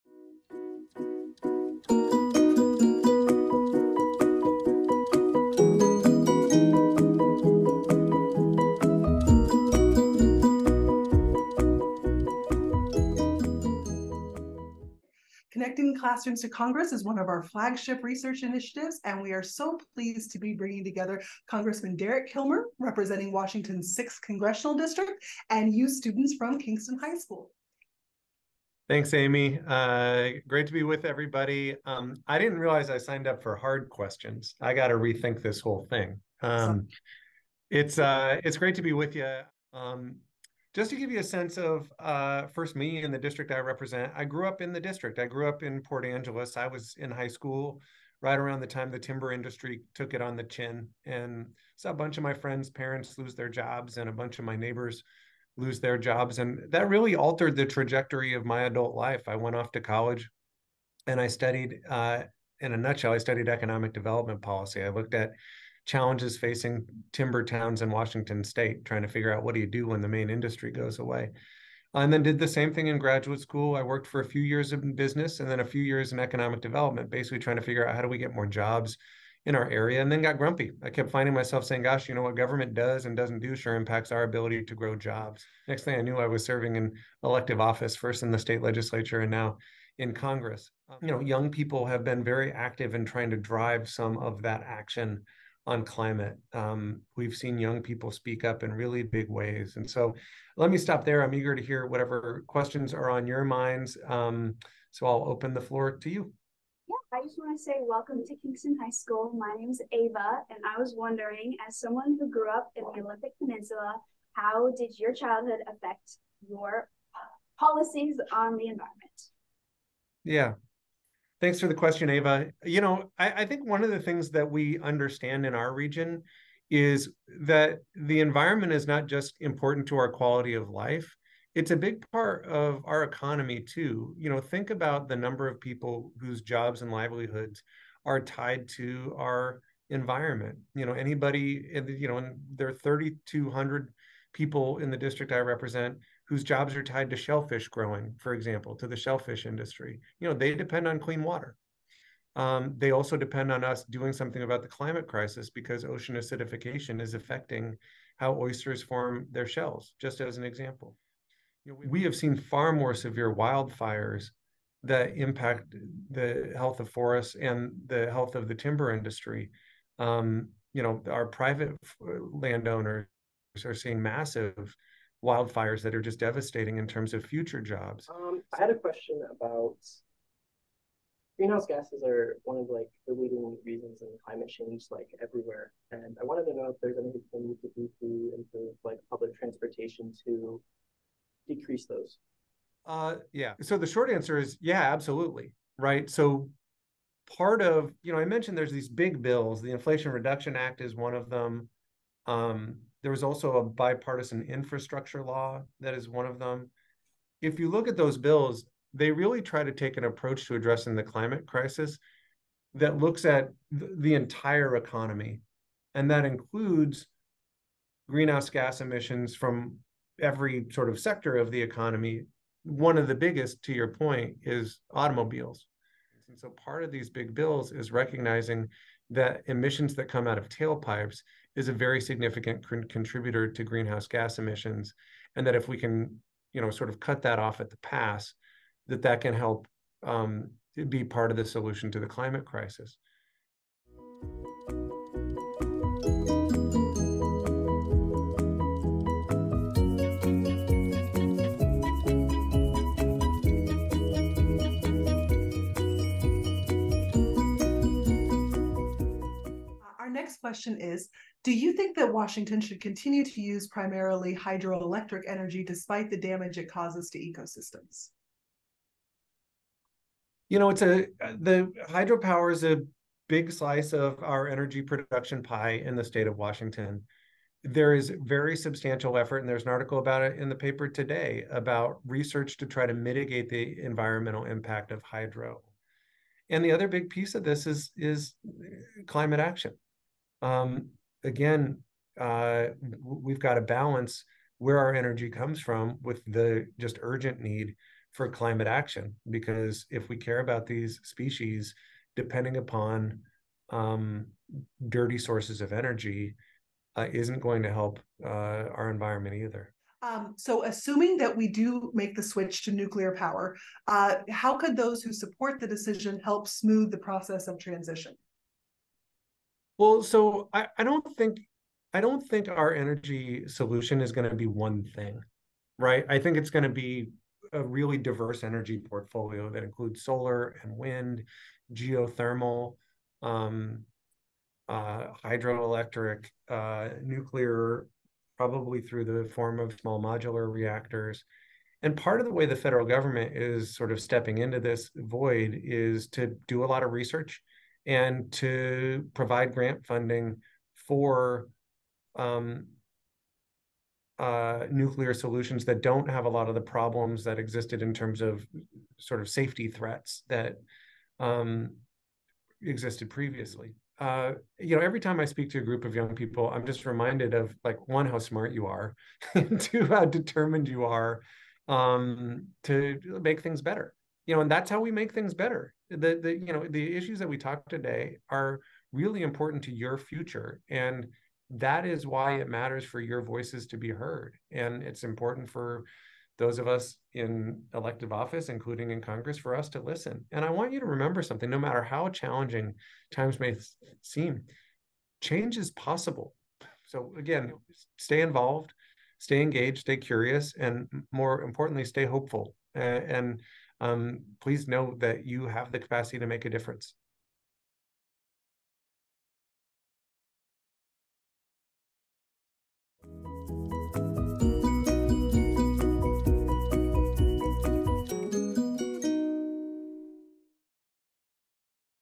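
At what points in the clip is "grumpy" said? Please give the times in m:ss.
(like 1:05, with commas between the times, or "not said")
1:20.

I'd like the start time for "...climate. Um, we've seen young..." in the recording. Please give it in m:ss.
1:35.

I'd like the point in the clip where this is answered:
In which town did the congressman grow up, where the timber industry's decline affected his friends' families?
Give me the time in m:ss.
0:45.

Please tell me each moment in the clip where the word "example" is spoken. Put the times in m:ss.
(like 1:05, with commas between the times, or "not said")
2:28, 2:40.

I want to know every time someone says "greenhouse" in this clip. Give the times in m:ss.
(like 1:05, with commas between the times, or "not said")
3:01, 3:38, 3:53.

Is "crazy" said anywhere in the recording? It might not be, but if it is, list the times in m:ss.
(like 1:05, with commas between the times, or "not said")
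not said.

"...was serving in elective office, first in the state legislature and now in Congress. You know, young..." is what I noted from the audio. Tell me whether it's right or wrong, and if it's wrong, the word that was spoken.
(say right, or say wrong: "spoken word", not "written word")
right.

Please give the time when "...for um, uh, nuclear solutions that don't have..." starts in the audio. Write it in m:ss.
5:50.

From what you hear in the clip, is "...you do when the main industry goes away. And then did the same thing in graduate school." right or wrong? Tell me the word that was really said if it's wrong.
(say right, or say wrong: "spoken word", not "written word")
right.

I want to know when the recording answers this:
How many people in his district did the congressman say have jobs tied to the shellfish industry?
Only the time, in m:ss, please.
2:22.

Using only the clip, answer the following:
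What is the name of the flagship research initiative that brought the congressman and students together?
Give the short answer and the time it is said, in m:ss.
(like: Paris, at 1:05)
Connecting Classrooms to Congress, at 0:15.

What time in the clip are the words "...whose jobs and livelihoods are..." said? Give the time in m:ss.
2:16.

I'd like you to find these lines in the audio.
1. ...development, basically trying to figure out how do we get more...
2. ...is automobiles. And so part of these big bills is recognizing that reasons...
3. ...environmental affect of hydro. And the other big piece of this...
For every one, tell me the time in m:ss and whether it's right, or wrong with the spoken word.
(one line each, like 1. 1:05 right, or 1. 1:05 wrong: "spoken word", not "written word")
1. 1:16 right
2. 3:44 wrong: "emissions", not "reasons"
3. 4:43 wrong: "impact", not "affect".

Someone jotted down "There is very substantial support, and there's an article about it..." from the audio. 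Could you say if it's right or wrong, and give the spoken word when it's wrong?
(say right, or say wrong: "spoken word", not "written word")
wrong: "effort", not "support".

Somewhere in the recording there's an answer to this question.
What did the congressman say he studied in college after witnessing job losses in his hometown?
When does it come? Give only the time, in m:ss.
1:03.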